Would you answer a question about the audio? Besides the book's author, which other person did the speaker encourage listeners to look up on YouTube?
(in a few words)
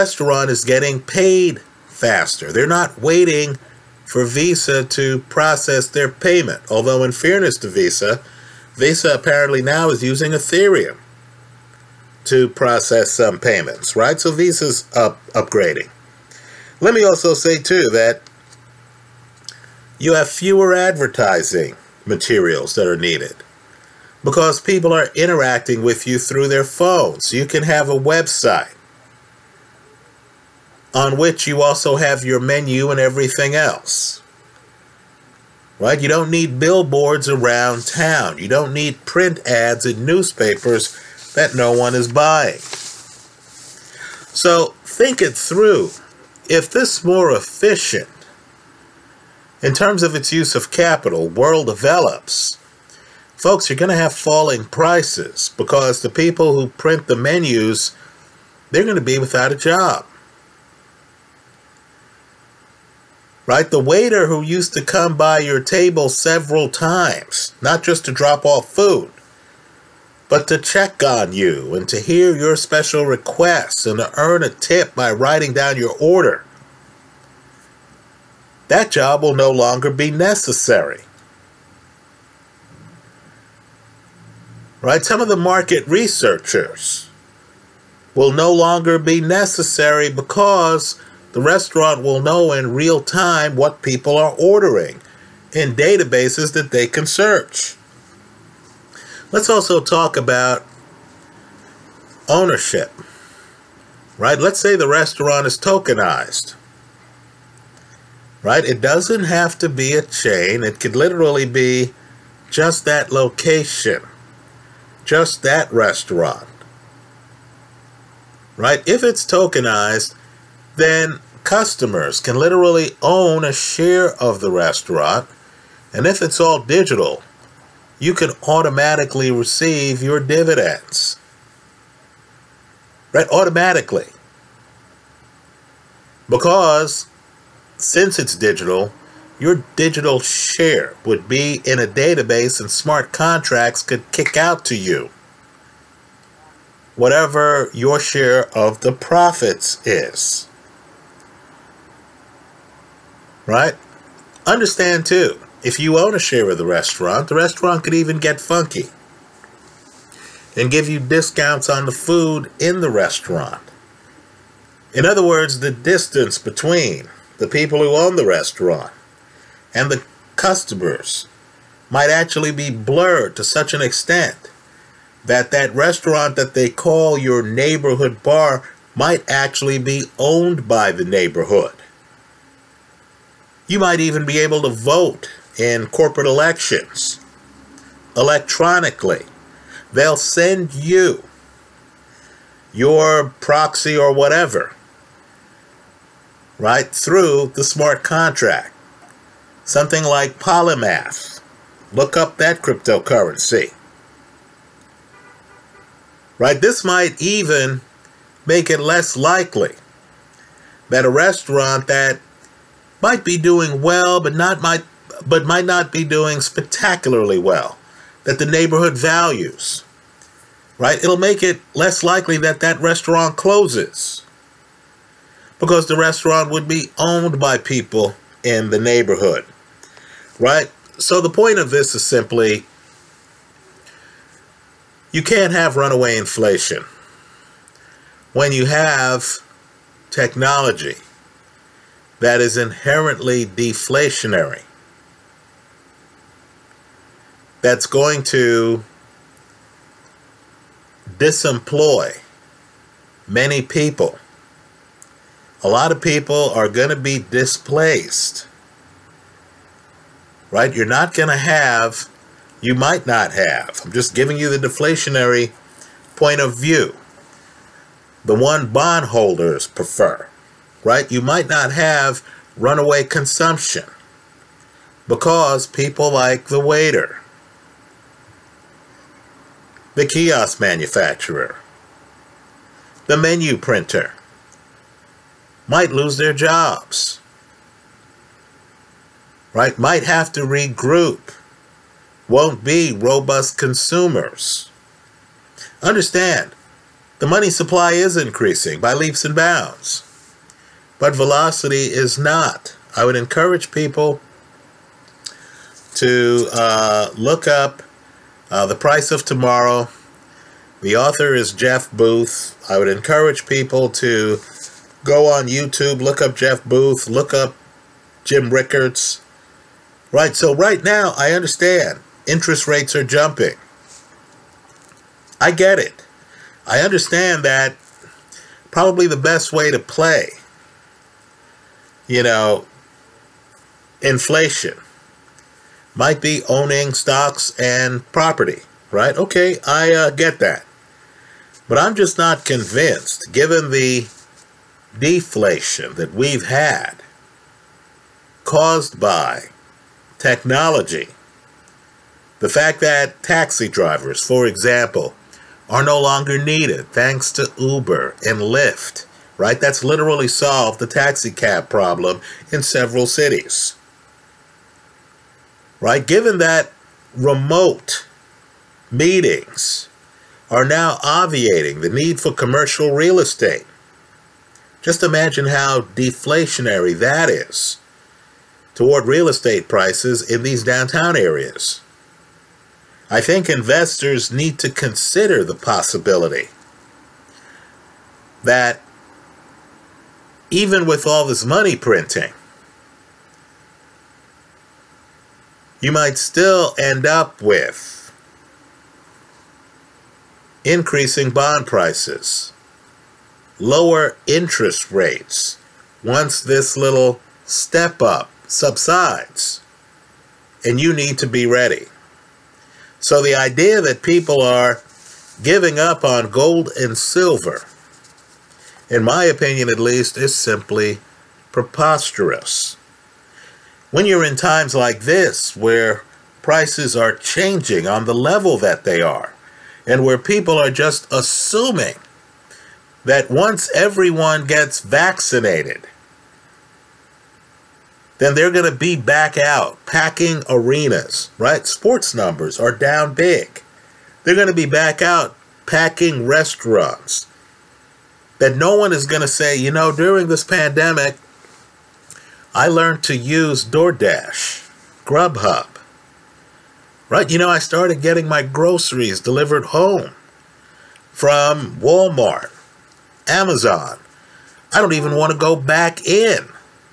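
Jim Rickards.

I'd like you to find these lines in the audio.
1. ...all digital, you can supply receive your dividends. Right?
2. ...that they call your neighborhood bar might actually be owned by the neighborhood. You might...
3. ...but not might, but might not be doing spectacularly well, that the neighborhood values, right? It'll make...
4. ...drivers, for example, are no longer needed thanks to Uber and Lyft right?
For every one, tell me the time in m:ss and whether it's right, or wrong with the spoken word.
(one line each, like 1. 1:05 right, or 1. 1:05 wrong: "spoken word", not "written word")
1. 2:06 wrong: "automatically", not "supply"
2. 2:56 right
3. 3:34 right
4. 5:53 right.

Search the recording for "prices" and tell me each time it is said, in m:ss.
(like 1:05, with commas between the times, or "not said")
0:54, 5:08, 6:19, 6:41, 7:06.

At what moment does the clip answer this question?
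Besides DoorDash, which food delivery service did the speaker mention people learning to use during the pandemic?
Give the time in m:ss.
7:35.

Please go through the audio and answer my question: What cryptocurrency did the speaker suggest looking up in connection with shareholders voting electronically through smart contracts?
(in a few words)
Polymath.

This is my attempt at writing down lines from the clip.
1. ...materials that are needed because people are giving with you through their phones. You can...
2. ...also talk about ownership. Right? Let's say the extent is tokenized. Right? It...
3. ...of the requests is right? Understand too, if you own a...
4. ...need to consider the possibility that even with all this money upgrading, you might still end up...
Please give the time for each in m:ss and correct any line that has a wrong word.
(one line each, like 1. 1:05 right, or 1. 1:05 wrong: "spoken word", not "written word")
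1. 0:22 wrong: "interacting", not "giving"
2. 1:39 wrong: "restaurant", not "extent"
3. 2:28 wrong: "profits", not "requests"
4. 6:24 wrong: "printing", not "upgrading".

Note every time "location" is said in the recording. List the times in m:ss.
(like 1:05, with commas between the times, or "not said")
1:53.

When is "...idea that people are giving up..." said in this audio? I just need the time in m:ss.
6:53.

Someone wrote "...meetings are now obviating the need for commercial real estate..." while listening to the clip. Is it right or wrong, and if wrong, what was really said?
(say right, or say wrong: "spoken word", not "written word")
right.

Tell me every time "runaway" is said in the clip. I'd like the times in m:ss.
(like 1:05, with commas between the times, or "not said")
3:55, 4:32.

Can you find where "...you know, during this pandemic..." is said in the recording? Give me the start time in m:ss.
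7:29.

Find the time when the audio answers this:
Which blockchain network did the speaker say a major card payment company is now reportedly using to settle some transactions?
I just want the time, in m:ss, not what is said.
0:10.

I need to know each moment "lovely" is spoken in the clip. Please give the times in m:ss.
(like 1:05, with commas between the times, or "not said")
not said.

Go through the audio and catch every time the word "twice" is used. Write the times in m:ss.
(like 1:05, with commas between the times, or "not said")
not said.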